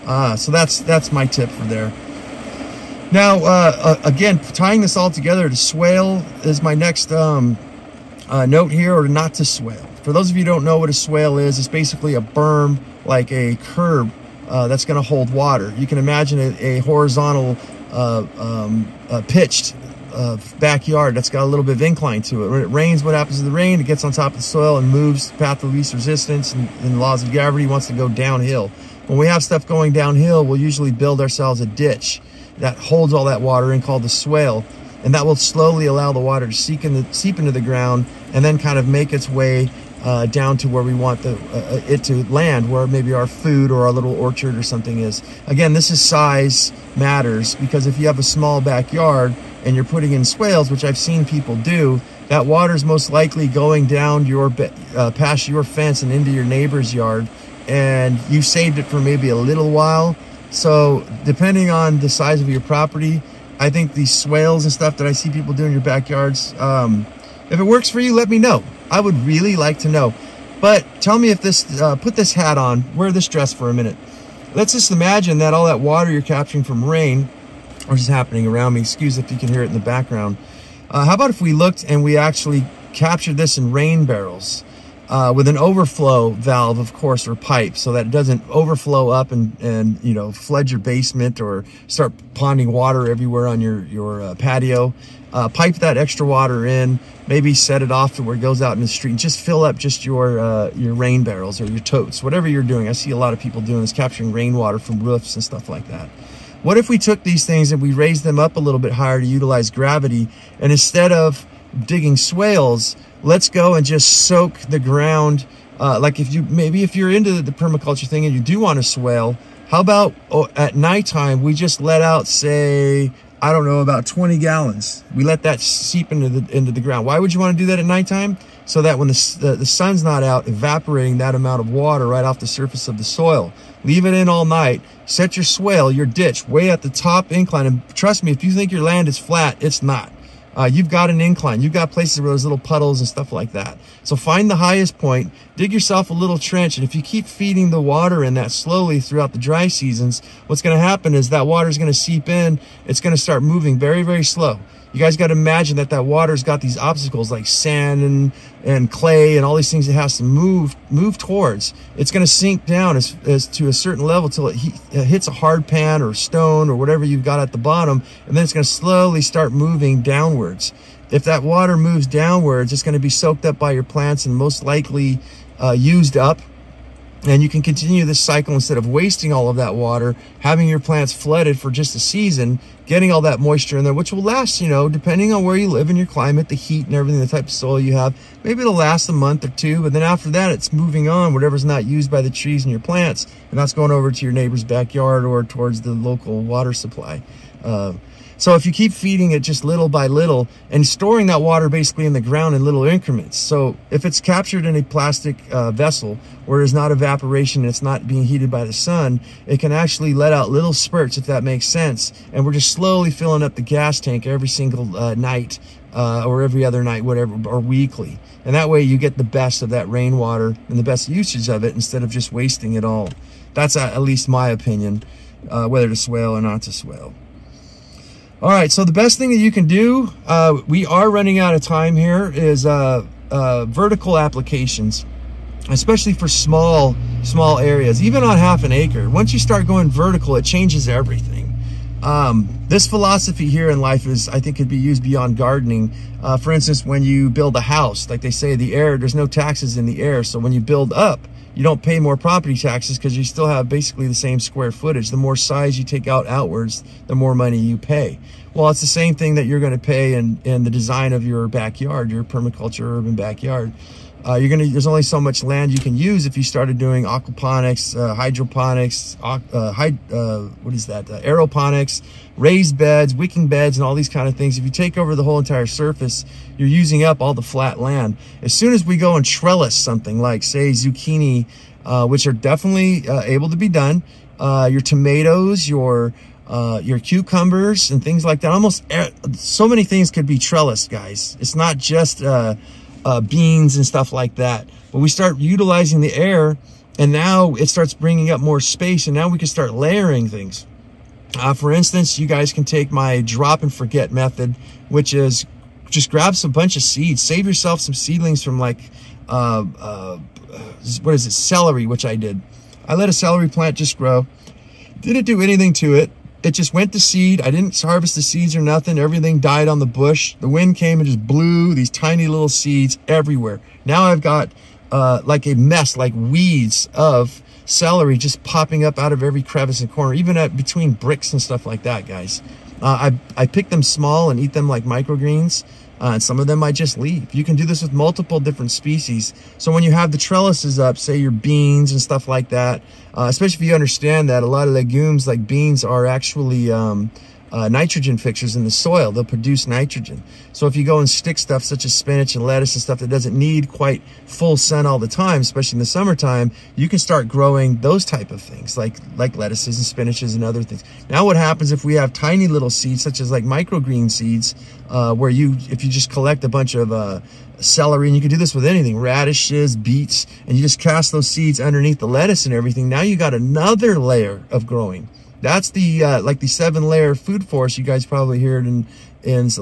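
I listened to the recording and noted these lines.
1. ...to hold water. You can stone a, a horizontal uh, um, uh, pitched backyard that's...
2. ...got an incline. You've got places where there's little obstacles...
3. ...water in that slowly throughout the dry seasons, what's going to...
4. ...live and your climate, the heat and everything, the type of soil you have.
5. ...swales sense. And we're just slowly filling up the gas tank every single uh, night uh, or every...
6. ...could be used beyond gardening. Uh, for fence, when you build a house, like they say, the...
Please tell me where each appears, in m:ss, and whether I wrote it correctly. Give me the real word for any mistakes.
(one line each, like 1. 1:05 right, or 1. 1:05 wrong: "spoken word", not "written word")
1. 0:15 wrong: "imagine", not "stone"
2. 2:20 wrong: "puddles", not "obstacles"
3. 2:27 right
4. 3:05 right
5. 3:31 wrong: "makes", not "swales"
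6. 4:04 wrong: "instance", not "fence".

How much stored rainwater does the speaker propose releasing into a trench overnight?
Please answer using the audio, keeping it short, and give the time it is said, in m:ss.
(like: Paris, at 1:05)
20 gallons, at 2:04.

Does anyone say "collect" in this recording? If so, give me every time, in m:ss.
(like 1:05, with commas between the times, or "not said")
6:06.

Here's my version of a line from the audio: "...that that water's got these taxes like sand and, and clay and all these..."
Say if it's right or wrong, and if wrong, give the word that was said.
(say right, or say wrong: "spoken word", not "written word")
wrong: "obstacles", not "taxes".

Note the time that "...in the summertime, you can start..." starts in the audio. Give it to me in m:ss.
5:55.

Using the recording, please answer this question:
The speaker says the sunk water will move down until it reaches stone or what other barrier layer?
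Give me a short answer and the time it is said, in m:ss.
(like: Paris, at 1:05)
hard pan, at 2:45.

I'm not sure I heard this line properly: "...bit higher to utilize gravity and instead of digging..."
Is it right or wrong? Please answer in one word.
right.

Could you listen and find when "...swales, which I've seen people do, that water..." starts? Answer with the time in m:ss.
0:50.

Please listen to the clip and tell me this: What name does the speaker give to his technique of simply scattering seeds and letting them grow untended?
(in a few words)
drop and forget method.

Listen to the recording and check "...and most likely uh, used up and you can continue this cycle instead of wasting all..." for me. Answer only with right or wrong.
right.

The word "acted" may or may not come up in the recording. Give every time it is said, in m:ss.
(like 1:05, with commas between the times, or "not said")
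not said.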